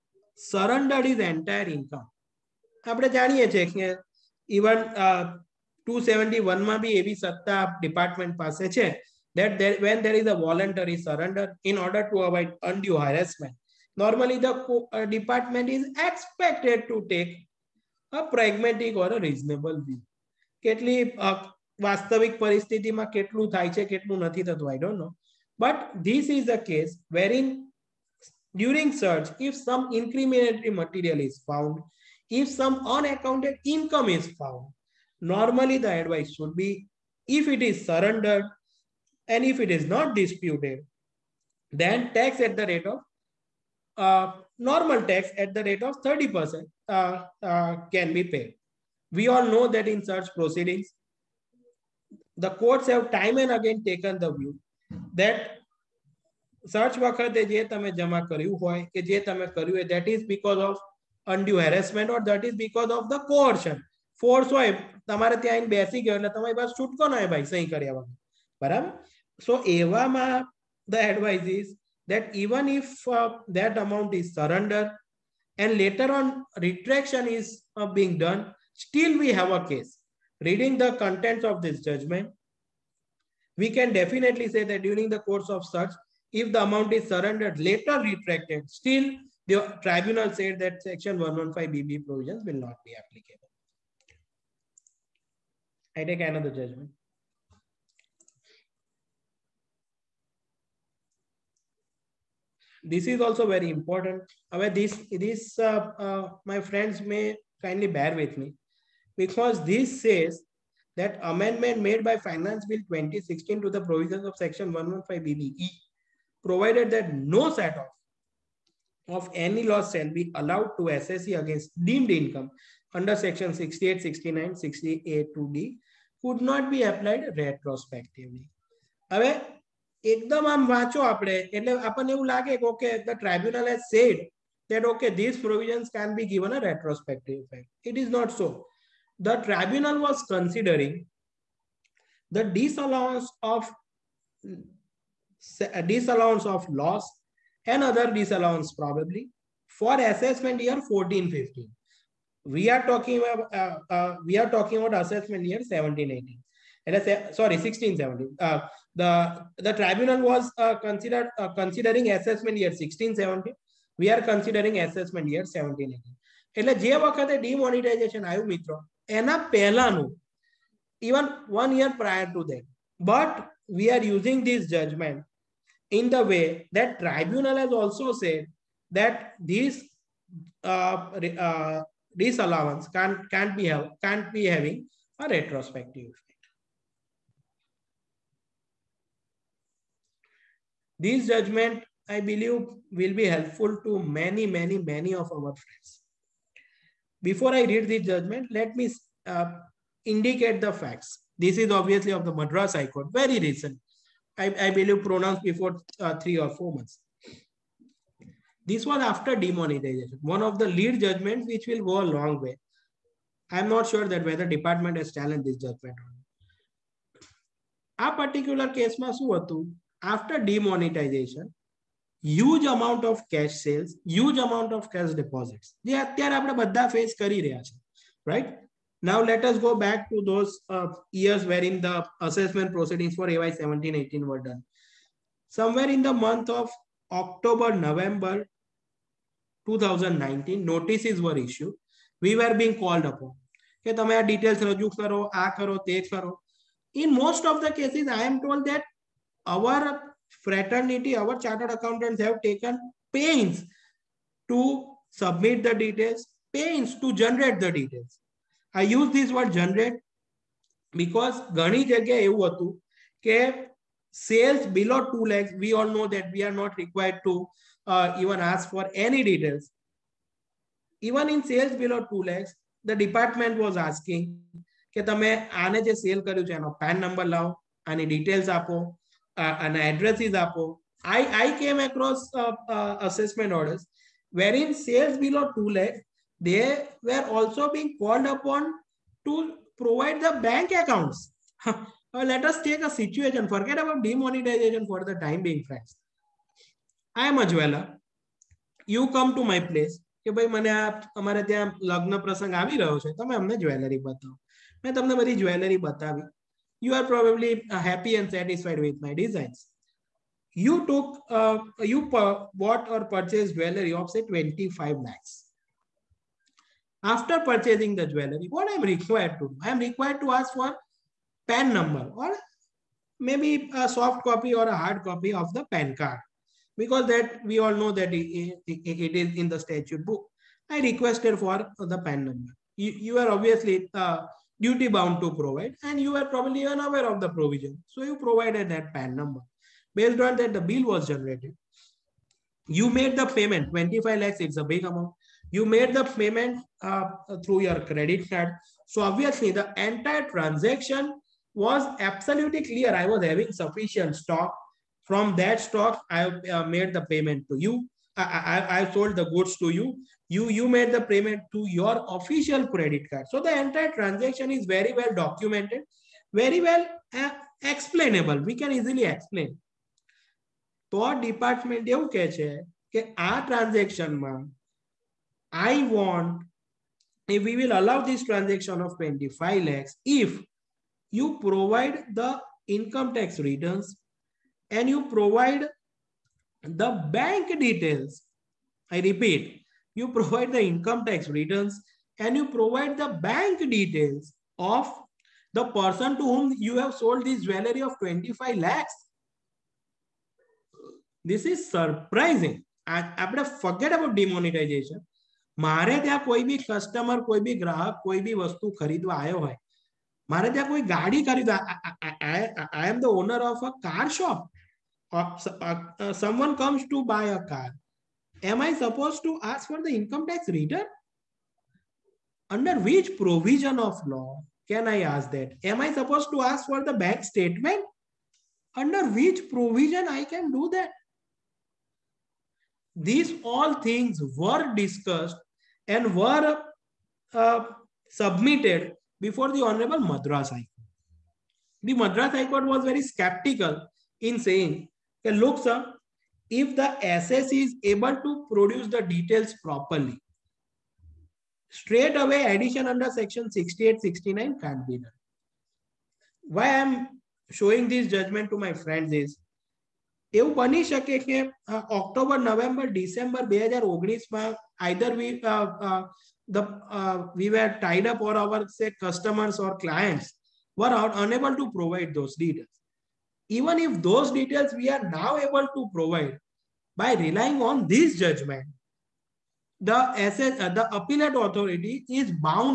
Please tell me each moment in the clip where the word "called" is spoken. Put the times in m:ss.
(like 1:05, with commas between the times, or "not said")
4:02, 4:47.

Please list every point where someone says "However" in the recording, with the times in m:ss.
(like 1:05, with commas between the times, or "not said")
1:44, 2:09.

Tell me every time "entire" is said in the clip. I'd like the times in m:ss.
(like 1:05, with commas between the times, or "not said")
5:49, 6:03.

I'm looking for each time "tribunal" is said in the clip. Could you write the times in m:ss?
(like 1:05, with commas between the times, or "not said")
1:29, 2:19, 2:39, 2:57.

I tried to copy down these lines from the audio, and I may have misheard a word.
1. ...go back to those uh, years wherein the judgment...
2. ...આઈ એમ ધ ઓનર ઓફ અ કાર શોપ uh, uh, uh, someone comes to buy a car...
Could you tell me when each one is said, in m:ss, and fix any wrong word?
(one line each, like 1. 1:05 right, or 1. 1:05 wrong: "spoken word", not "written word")
1. 3:49 wrong: "assessment", not "judgment"
2. 6:52 right.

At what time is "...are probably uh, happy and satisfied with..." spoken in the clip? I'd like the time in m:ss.
5:06.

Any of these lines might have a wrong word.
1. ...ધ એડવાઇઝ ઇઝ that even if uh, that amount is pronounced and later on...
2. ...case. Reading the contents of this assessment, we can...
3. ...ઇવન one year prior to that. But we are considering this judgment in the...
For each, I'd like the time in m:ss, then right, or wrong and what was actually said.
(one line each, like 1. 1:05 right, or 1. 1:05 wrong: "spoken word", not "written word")
1. 1:10 wrong: "surrendered", not "pronounced"
2. 1:19 wrong: "judgment", not "assessment"
3. 2:51 wrong: "using", not "considering".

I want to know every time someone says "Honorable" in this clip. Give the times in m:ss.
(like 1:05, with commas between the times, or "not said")
7:19.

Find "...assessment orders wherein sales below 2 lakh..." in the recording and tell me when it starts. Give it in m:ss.
4:43.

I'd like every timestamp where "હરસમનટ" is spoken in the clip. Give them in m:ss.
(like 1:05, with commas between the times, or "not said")
0:13, 1:01.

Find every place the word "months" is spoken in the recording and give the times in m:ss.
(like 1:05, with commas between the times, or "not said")
3:26, 3:56.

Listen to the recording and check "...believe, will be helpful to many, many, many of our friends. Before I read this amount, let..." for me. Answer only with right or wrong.
wrong.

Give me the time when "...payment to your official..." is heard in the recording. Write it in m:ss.
6:01.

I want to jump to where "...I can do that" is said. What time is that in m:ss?
7:10.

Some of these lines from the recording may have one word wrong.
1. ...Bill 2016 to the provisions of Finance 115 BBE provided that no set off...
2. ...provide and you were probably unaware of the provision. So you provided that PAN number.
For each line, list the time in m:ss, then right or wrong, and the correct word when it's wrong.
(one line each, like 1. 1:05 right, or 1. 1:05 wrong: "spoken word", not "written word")
1. 1:52 wrong: "Section", not "Finance"
2. 5:35 right.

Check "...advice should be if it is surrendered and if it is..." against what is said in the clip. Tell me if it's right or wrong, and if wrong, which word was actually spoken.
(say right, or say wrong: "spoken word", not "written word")
right.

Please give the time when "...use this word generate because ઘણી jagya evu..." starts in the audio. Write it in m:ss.
4:18.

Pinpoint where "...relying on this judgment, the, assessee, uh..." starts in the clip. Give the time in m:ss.
7:57.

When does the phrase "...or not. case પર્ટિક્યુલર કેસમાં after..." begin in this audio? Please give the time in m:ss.
3:36.